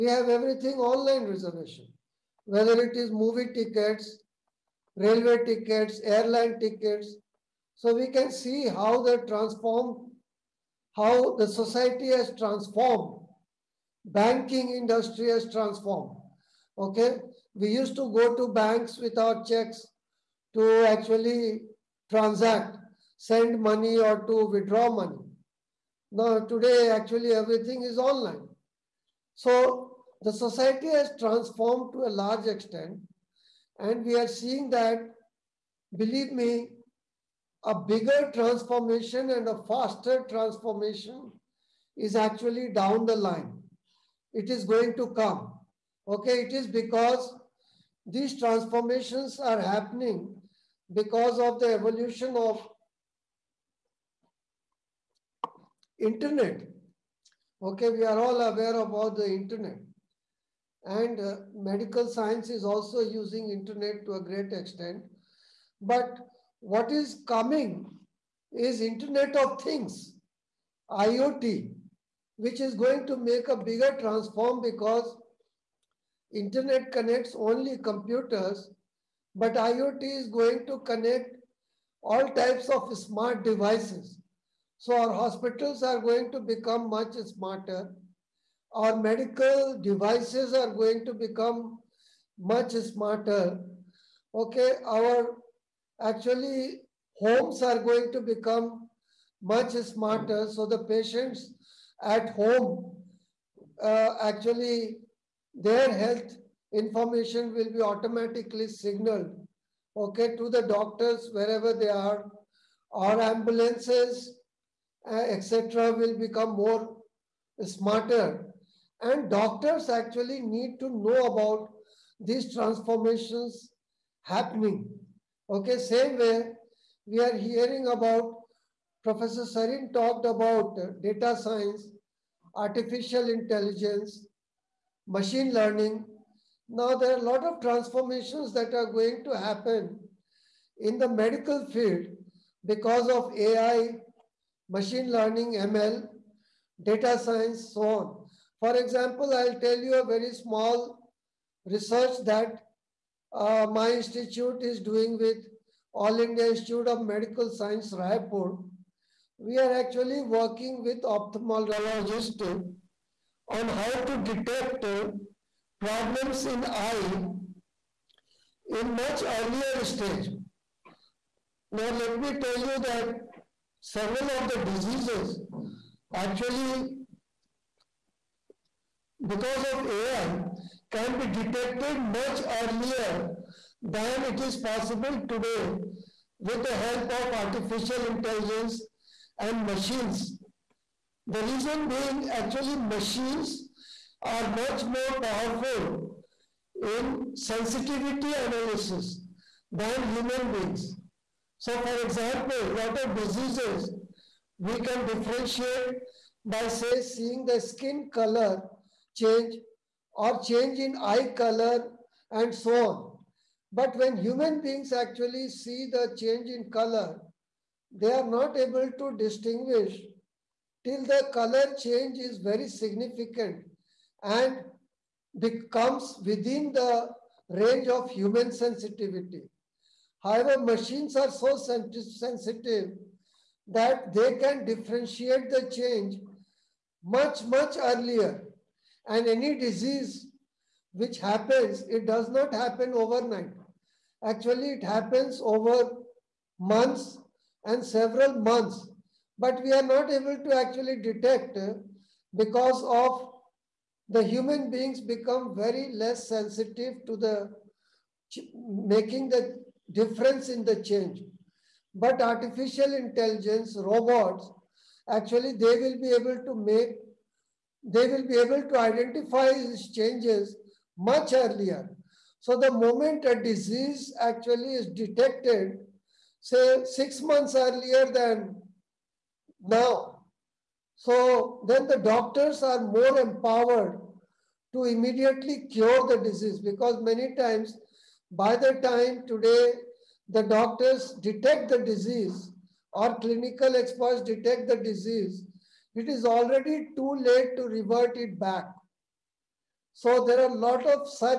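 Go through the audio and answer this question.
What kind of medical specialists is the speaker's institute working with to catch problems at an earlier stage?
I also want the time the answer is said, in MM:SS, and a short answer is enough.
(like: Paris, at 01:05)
Ophthalmologists, at 02:41.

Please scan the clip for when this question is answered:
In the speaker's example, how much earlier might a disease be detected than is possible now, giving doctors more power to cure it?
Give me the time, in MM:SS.
04:36.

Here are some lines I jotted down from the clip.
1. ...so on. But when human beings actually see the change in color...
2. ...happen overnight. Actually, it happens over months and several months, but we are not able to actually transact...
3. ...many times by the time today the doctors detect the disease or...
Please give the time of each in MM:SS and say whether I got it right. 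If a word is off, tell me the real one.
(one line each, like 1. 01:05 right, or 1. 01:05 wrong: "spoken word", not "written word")
1. 03:32 right
2. 04:02 wrong: "detect", not "transact"
3. 04:47 right.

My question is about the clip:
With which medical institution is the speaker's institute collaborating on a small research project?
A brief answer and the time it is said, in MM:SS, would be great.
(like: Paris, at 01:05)
All India Institute of Medical Science, Raipur, at 02:35.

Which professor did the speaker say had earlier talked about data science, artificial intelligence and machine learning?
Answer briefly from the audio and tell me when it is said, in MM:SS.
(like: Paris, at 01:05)
Professor Sarin, at 02:09.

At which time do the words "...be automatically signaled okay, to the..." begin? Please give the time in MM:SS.
01:47.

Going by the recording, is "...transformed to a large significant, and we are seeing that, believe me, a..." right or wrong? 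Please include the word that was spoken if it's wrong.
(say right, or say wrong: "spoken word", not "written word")
wrong: "extent", not "significant".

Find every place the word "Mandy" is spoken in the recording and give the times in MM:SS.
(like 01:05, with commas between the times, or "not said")
not said.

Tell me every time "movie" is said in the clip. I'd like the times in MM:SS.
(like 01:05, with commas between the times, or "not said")
00:03.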